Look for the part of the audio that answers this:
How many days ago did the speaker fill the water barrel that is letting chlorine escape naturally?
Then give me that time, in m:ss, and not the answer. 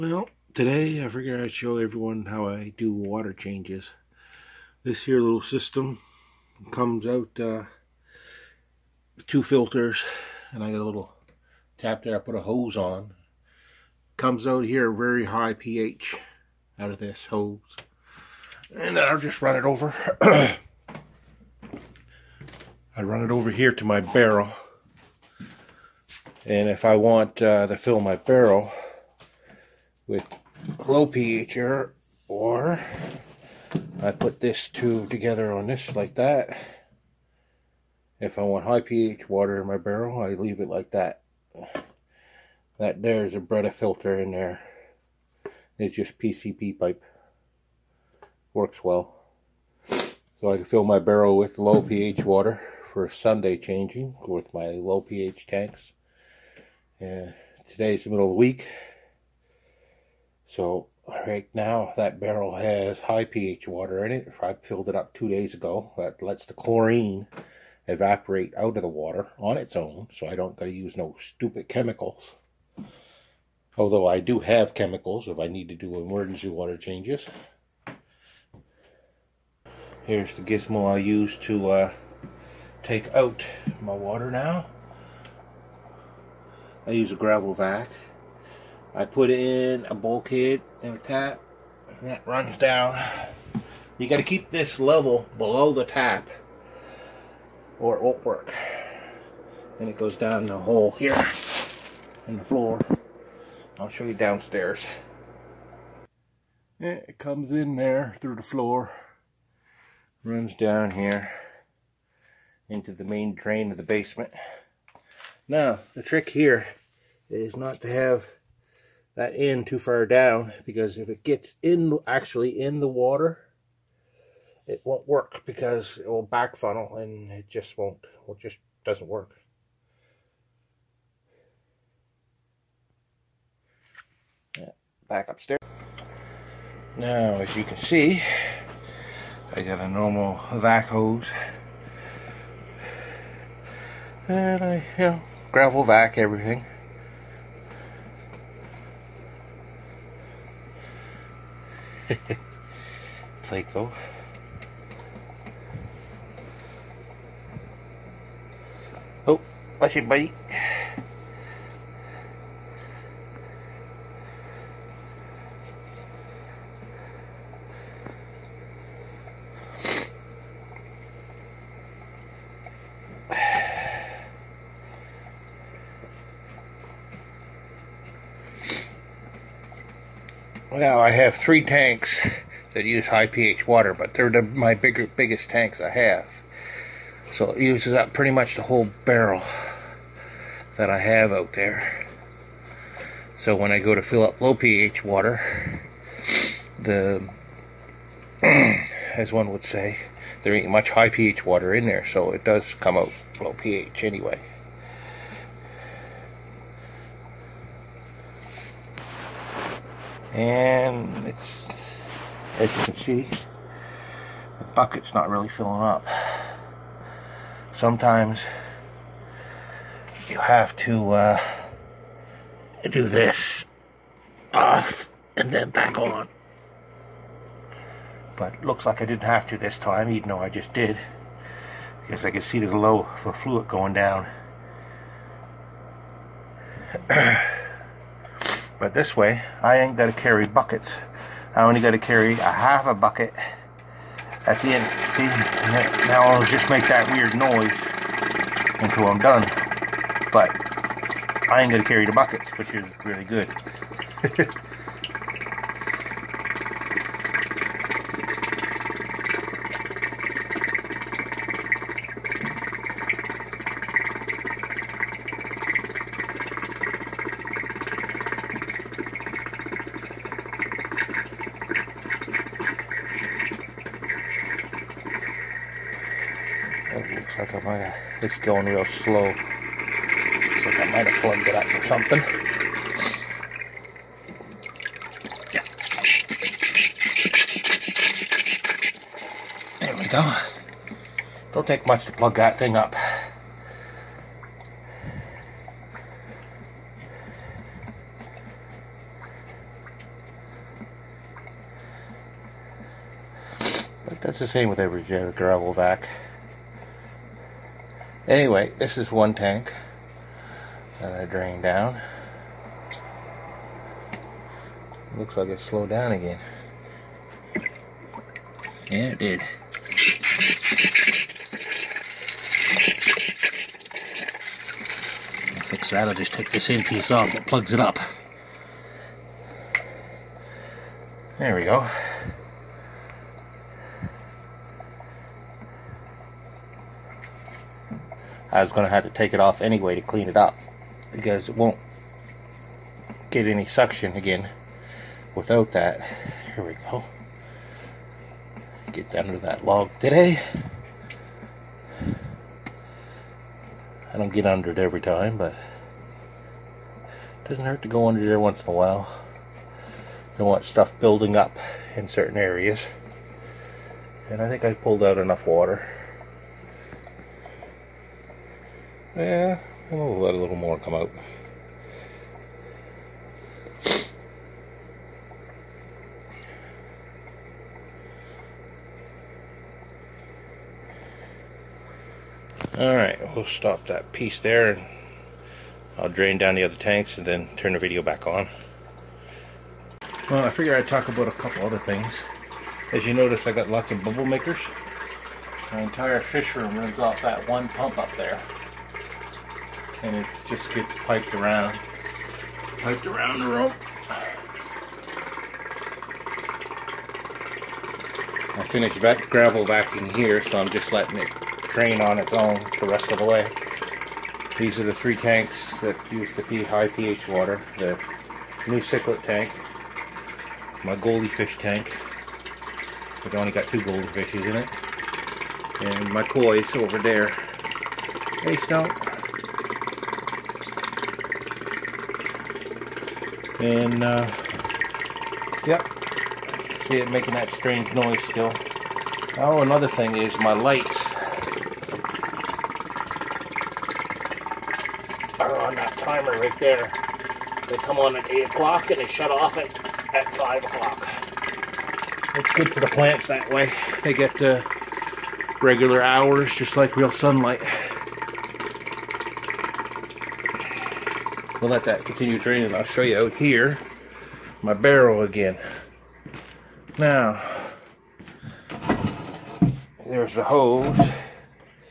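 1:05.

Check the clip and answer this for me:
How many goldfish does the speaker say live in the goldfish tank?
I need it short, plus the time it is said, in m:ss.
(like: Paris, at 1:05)
2, at 7:03.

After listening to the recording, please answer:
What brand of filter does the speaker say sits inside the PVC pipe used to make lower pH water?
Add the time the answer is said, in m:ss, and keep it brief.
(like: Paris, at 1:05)
Brita, at 0:43.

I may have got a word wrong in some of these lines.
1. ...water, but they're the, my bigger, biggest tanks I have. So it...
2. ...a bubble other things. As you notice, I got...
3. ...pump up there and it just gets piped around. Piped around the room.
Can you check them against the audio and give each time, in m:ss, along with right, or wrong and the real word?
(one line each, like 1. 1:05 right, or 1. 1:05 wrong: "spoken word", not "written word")
1. 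3:03 right
2. 6:31 wrong: "couple", not "bubble"
3. 6:37 right.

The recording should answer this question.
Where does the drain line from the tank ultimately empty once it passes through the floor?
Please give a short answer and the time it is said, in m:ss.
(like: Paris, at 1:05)
main drain of the basement, at 1:53.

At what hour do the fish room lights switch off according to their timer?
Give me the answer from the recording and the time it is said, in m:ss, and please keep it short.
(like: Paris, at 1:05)
5 o'clock, at 7:30.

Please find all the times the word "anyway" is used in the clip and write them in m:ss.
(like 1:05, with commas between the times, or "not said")
3:24, 5:08, 5:39.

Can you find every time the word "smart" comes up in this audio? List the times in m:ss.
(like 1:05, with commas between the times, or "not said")
not said.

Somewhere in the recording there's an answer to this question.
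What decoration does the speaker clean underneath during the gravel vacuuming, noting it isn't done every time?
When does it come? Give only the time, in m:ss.
5:49.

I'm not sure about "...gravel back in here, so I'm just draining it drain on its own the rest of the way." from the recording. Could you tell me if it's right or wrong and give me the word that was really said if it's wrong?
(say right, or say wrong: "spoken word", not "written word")
wrong: "letting", not "draining".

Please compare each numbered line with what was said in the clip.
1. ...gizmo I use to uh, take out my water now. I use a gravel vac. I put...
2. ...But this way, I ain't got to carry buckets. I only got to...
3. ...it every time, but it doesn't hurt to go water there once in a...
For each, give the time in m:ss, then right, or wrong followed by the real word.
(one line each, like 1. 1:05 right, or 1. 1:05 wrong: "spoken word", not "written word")
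1. 1:20 right
2. 3:58 right
3. 5:54 wrong: "under", not "water".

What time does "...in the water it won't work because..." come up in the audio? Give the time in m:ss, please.
2:02.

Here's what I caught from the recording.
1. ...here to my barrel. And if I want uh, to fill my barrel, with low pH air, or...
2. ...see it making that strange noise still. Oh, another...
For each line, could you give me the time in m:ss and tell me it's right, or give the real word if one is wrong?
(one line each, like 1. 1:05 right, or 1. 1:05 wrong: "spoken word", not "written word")
1. 0:23 right
2. 7:16 right.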